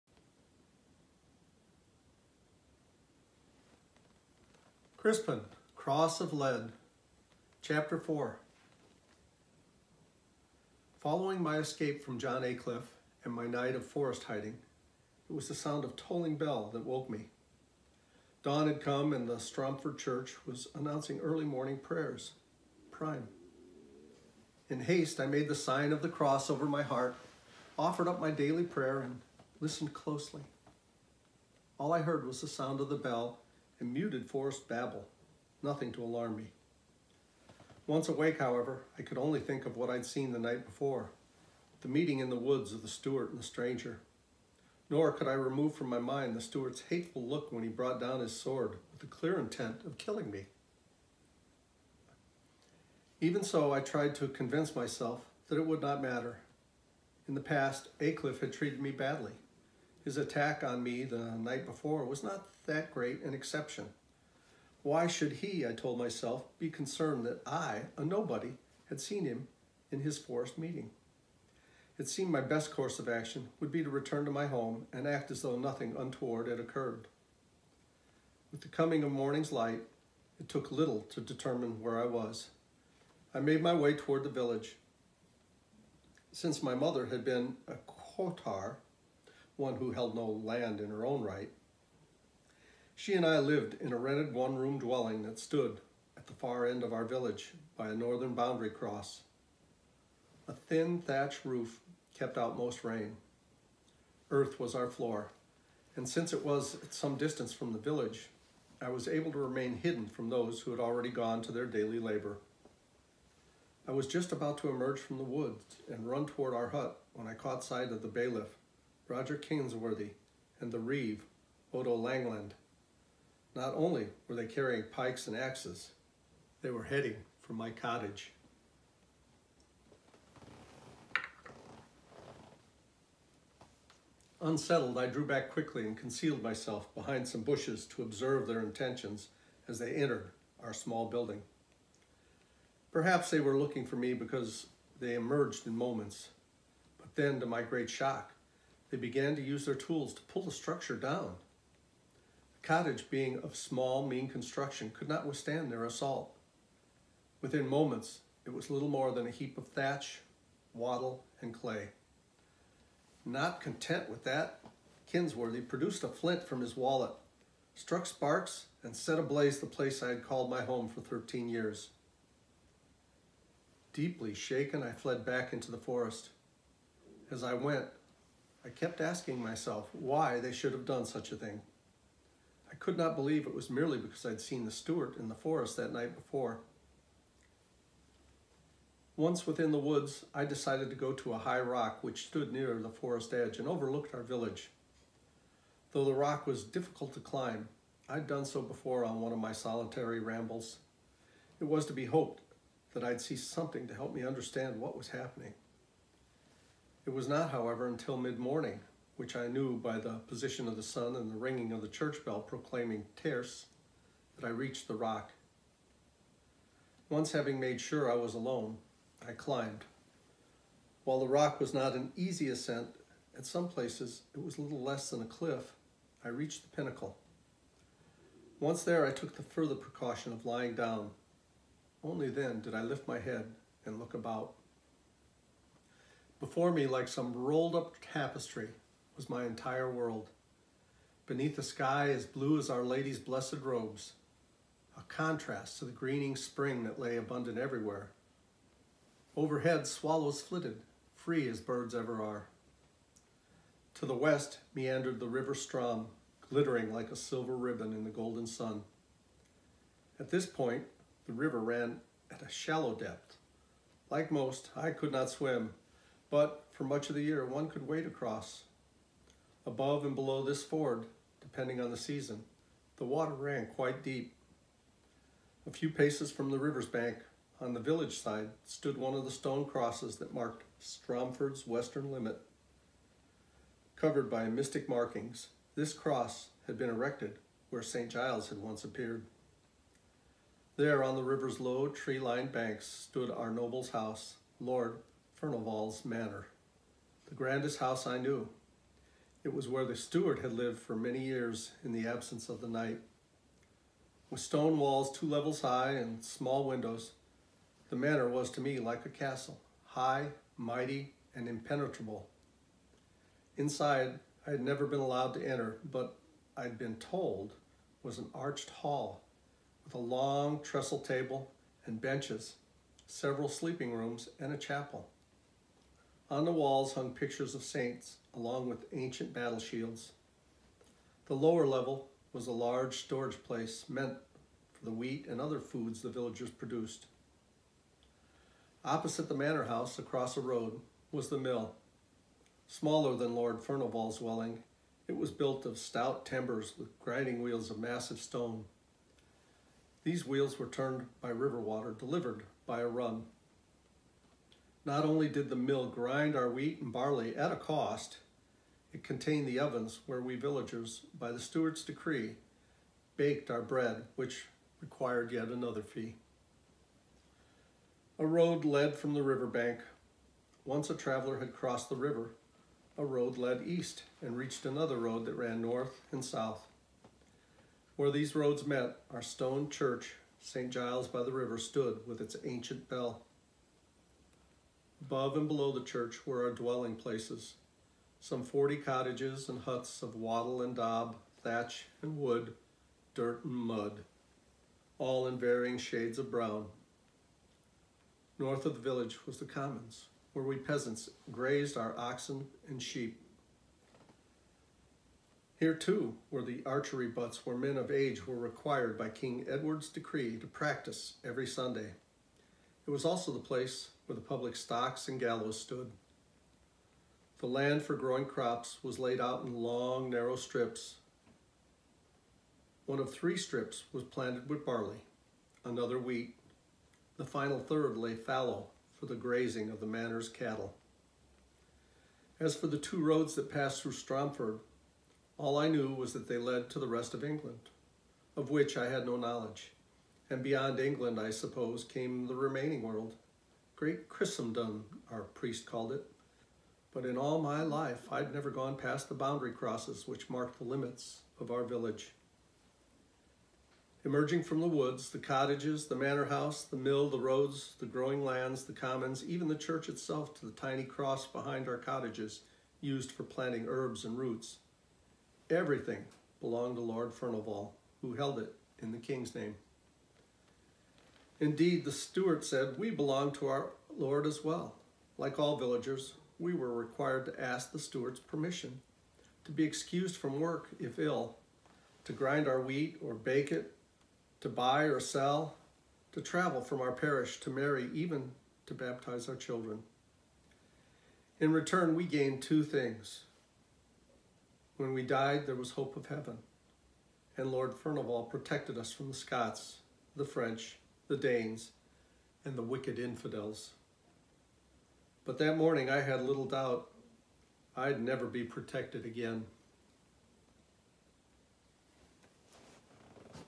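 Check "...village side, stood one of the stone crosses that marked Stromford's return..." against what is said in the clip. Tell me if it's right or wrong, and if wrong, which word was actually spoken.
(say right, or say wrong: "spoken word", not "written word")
wrong: "western", not "return".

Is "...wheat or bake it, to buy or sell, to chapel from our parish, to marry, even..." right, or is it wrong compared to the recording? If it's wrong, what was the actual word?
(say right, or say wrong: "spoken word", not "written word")
wrong: "travel", not "chapel".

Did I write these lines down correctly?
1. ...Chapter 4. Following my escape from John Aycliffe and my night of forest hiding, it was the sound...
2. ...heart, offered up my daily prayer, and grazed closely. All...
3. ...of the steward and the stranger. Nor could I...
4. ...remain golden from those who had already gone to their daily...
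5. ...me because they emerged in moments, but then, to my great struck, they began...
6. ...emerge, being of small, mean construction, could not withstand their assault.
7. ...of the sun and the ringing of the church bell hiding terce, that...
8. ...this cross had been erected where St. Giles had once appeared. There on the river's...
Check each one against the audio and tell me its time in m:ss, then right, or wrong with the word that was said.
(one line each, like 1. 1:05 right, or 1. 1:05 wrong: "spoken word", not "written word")
1. 0:07 right
2. 0:26 wrong: "listened", not "grazed"
3. 0:42 right
4. 1:49 wrong: "hidden", not "golden"
5. 2:23 wrong: "shock", not "struck"
6. 2:32 wrong: "cottage", not "emerge"
7. 3:30 wrong: "proclaiming", not "hiding"
8. 4:45 right.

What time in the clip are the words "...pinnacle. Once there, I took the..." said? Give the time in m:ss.
3:46.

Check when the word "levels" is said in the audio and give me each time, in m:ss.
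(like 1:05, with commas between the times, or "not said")
5:05, 5:31.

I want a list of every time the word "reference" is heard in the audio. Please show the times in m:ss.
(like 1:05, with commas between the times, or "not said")
not said.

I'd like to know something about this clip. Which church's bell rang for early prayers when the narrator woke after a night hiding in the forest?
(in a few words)
Stromford Church.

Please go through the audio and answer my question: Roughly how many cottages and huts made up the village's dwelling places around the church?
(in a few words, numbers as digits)
40.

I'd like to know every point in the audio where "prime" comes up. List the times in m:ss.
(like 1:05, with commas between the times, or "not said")
0:22.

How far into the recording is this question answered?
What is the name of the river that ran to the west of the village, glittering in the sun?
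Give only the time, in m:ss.
4:15.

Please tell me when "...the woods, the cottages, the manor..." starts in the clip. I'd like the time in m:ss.
7:34.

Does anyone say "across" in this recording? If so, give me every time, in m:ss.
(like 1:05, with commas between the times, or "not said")
4:28, 5:39.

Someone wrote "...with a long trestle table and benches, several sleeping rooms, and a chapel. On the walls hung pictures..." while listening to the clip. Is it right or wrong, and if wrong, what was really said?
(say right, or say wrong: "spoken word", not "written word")
right.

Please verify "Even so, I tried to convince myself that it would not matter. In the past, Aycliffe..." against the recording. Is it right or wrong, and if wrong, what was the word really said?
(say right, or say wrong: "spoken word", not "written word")
right.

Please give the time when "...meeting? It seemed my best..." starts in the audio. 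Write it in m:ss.
1:10.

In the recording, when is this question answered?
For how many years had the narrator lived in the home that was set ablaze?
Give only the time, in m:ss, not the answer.
2:51.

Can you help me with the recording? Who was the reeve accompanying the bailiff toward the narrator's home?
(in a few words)
Odo Langland.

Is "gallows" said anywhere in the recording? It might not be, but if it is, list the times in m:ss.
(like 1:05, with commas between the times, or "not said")
6:55.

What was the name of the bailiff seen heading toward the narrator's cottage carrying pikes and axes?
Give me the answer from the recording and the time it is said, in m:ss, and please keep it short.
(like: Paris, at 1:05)
Roger Kingsworthy, at 1:59.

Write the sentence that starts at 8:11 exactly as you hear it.
In return, we gained two things.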